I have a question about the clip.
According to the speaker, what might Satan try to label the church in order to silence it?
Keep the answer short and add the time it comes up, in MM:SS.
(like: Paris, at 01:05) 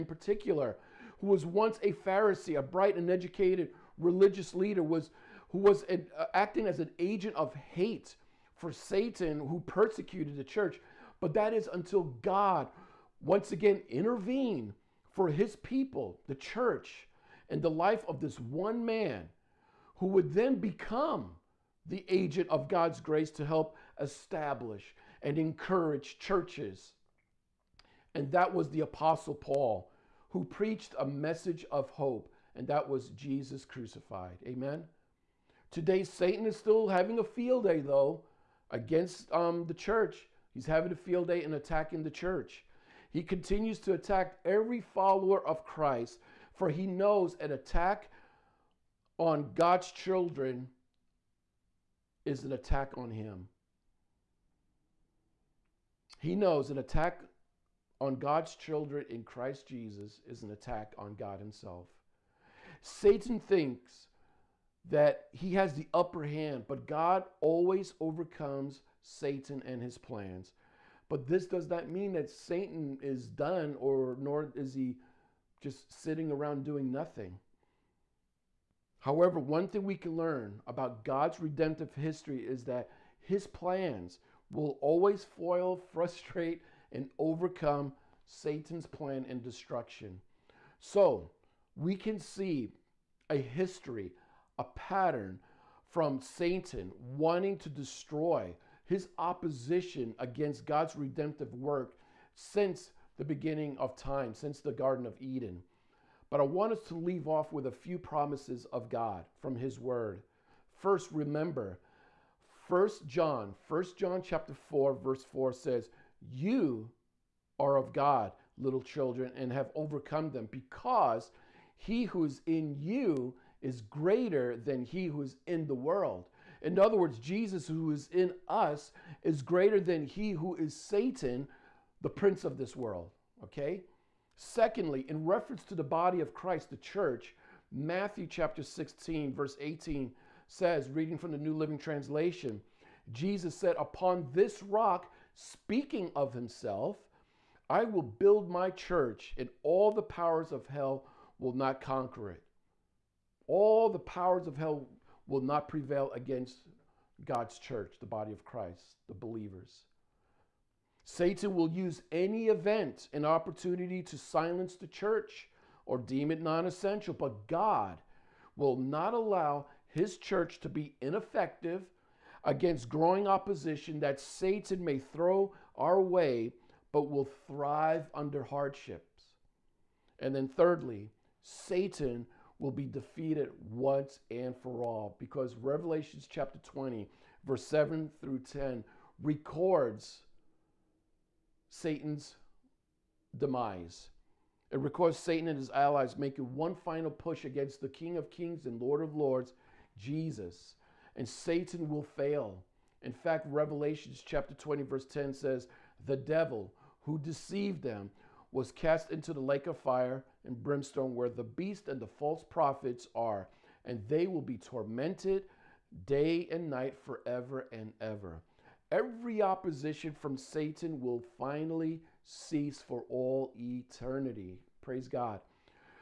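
non essential, at 02:46.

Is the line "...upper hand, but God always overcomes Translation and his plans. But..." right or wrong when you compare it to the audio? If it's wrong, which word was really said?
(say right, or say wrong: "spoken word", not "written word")
wrong: "Satan", not "Translation".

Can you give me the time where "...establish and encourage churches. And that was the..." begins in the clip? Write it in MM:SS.
00:23.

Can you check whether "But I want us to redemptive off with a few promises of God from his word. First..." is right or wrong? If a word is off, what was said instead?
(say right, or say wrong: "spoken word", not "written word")
wrong: "leave", not "redemptive".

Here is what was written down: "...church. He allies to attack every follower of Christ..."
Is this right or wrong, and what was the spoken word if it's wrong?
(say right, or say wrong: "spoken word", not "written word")
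wrong: "continues", not "allies".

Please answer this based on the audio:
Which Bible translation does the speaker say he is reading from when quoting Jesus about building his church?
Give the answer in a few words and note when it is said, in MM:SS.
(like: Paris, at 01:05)
New Living Translation, at 02:21.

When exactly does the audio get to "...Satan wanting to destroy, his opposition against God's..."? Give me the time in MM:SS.
01:36.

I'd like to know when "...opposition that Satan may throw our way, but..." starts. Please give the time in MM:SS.
02:53.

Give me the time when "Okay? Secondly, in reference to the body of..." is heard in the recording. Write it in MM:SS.
02:13.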